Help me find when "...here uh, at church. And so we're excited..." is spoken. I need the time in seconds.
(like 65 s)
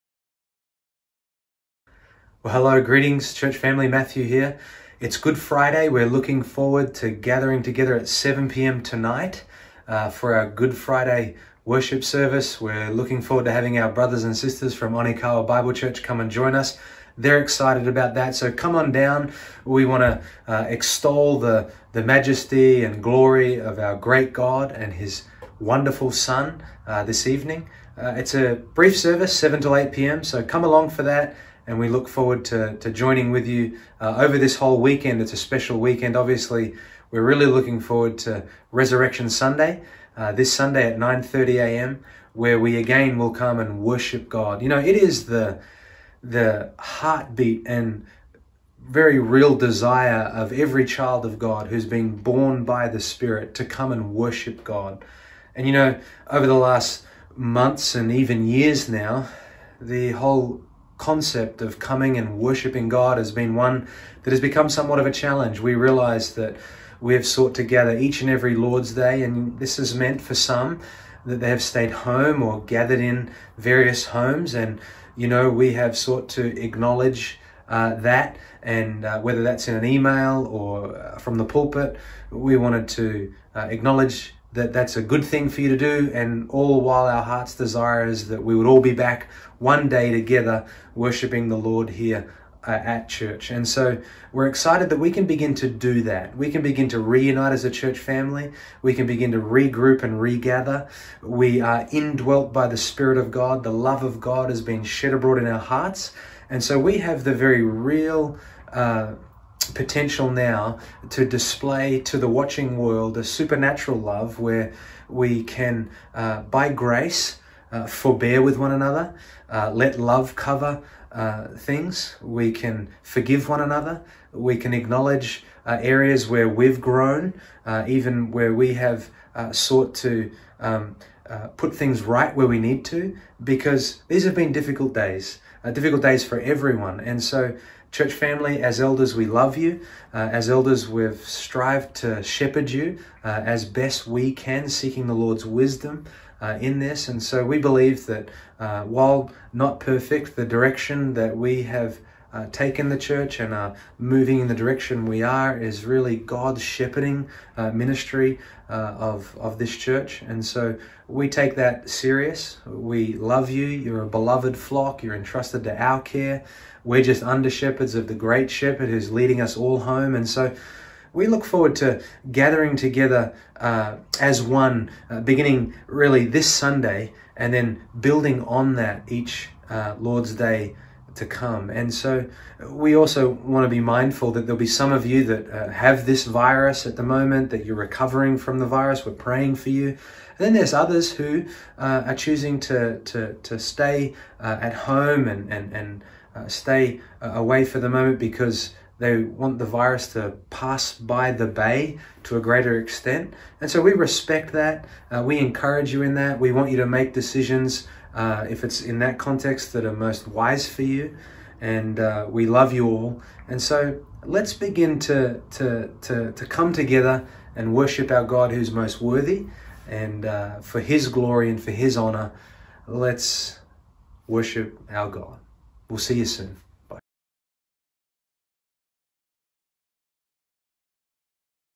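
91 s.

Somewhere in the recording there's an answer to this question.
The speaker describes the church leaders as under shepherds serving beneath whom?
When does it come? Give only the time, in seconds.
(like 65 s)
168 s.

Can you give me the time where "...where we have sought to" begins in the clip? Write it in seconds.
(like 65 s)
128 s.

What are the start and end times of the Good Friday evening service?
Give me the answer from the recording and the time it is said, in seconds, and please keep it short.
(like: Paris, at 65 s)
7 to 8 p.m., at 29 s.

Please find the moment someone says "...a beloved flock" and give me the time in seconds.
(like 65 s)
164 s.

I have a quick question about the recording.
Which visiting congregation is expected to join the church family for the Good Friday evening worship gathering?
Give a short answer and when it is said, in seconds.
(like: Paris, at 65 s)
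Onikawa Bible Church, at 14 s.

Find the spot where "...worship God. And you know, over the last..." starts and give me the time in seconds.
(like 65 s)
54 s.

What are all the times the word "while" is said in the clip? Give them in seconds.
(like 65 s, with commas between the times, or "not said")
86 s, 148 s.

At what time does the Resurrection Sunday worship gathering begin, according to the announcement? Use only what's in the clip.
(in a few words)
9:30 a.m.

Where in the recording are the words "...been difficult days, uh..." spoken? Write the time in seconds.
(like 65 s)
134 s.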